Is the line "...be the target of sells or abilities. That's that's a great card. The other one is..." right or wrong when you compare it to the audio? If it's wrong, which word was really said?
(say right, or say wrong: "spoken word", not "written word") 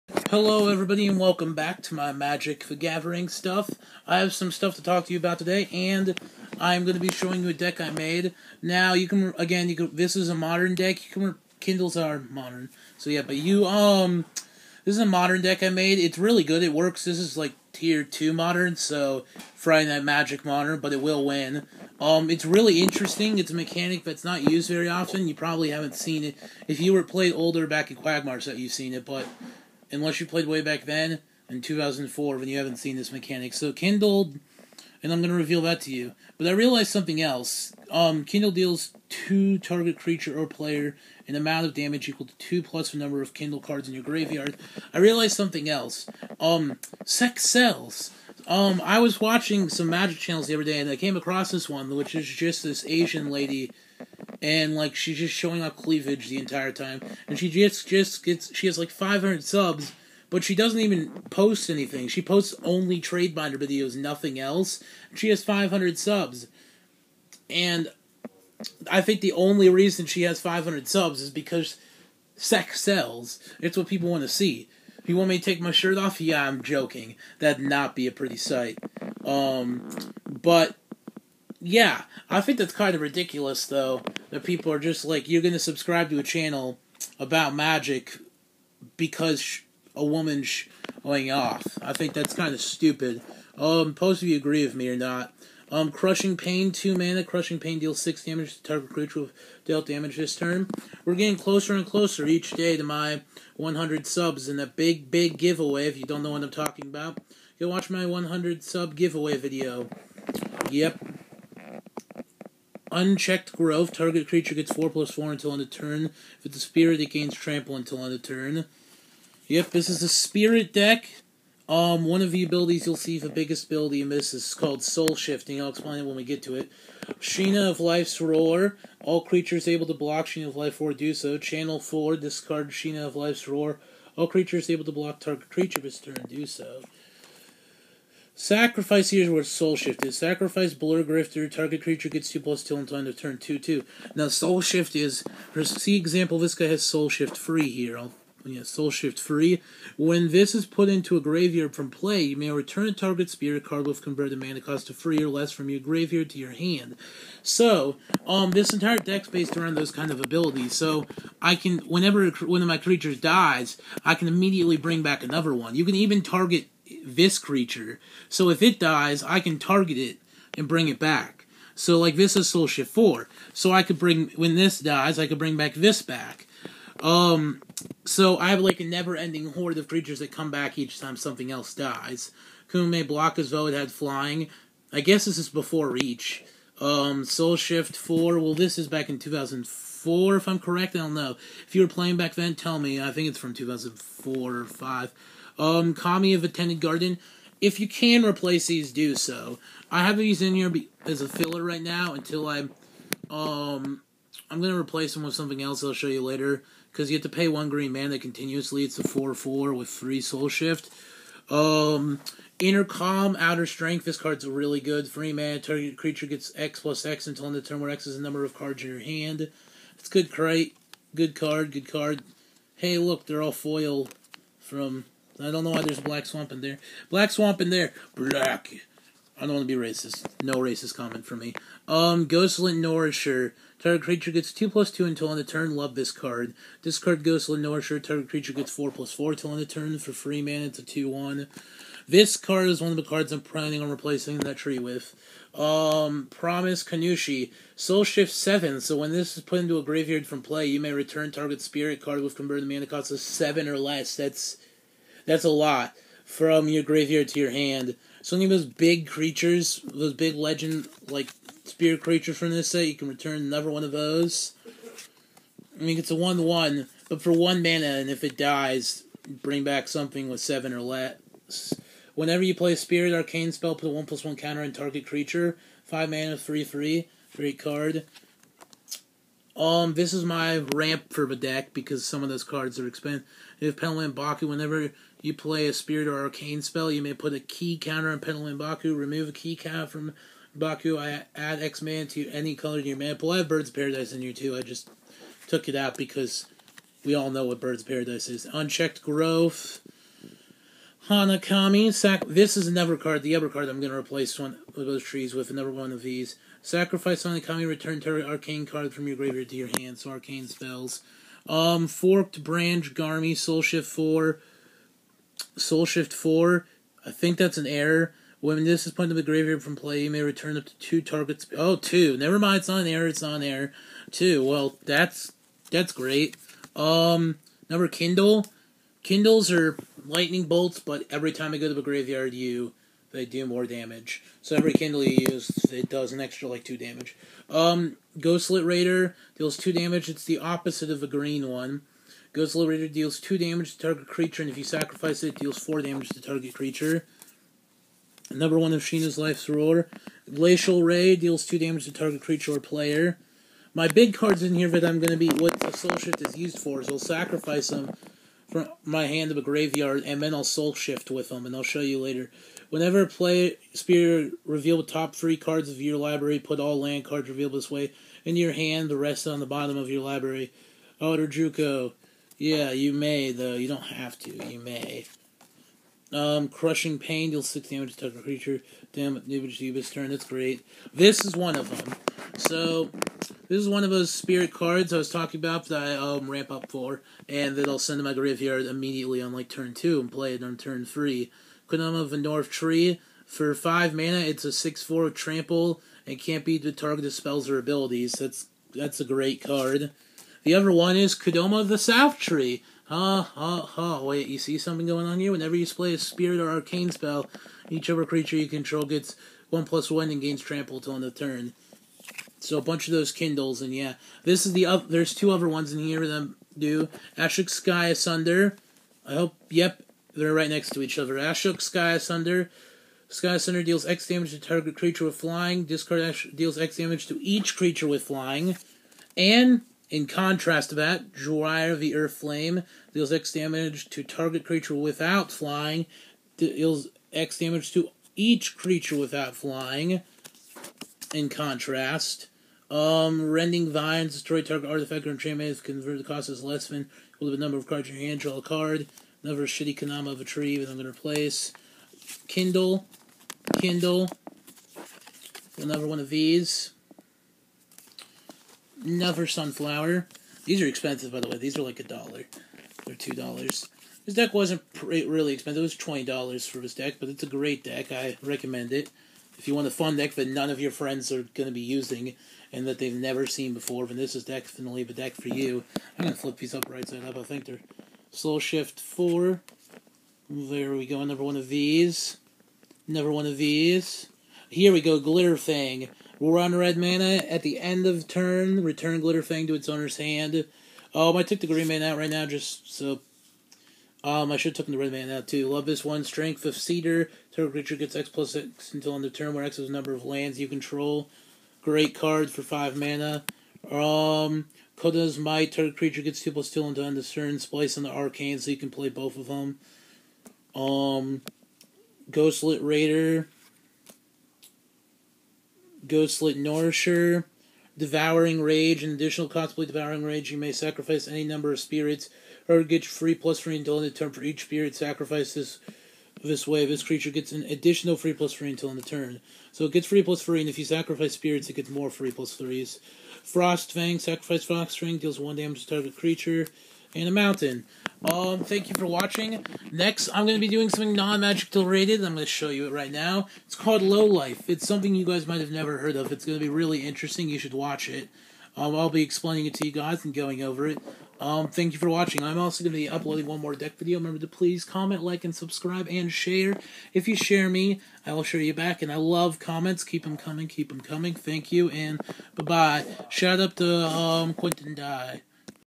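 wrong: "spells", not "sells".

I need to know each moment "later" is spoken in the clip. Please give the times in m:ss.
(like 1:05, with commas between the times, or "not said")
3:26, 6:01.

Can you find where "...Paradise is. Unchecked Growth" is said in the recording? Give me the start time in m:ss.
4:57.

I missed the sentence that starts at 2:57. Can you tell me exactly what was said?
Um, so I have like a never-ending horde of creatures that come back each time something else dies.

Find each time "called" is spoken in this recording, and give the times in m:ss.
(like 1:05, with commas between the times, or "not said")
2:04, 9:03.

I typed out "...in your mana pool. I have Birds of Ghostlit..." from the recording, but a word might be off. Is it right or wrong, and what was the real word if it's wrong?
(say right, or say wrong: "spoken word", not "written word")
wrong: "Paradise", not "Ghostlit".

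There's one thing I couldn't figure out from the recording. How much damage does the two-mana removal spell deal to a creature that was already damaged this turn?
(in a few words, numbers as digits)
6.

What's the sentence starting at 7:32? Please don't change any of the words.
Kindle, Kindle, another one of these.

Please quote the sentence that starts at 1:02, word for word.
She posts only trade binder videos, nothing else.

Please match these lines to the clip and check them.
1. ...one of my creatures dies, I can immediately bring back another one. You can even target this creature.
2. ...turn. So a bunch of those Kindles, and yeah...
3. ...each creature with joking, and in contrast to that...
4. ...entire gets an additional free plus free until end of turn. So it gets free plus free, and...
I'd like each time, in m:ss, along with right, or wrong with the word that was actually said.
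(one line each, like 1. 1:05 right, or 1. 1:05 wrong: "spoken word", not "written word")
1. 2:42 right
2. 6:51 right
3. 7:07 wrong: "flying", not "joking"
4. 8:46 wrong: "creature", not "entire".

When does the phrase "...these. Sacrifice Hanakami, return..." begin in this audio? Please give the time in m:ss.
5:06.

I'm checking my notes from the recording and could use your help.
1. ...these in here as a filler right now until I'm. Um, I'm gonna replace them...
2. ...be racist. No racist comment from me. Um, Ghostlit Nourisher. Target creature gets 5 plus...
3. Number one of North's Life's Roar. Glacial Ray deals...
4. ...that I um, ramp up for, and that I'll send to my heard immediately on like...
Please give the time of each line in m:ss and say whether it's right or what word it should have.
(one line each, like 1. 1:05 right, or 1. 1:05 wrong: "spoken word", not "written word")
1. 3:20 right
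2. 3:49 wrong: "2", not "5"
3. 5:48 wrong: "Sheena", not "North"
4. 6:25 wrong: "graveyard", not "heard".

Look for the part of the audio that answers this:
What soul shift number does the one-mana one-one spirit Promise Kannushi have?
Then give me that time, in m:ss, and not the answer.
4:07.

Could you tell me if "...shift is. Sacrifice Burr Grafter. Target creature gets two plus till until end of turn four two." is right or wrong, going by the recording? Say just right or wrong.
wrong.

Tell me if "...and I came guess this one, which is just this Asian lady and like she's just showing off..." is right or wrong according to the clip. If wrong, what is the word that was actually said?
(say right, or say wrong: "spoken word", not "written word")
wrong: "across", not "guess".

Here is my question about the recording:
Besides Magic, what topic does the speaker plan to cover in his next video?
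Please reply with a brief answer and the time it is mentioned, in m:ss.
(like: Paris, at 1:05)
Low Life, at 9:03.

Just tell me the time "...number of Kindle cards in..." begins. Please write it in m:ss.
0:42.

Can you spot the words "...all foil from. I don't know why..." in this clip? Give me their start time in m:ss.
3:43.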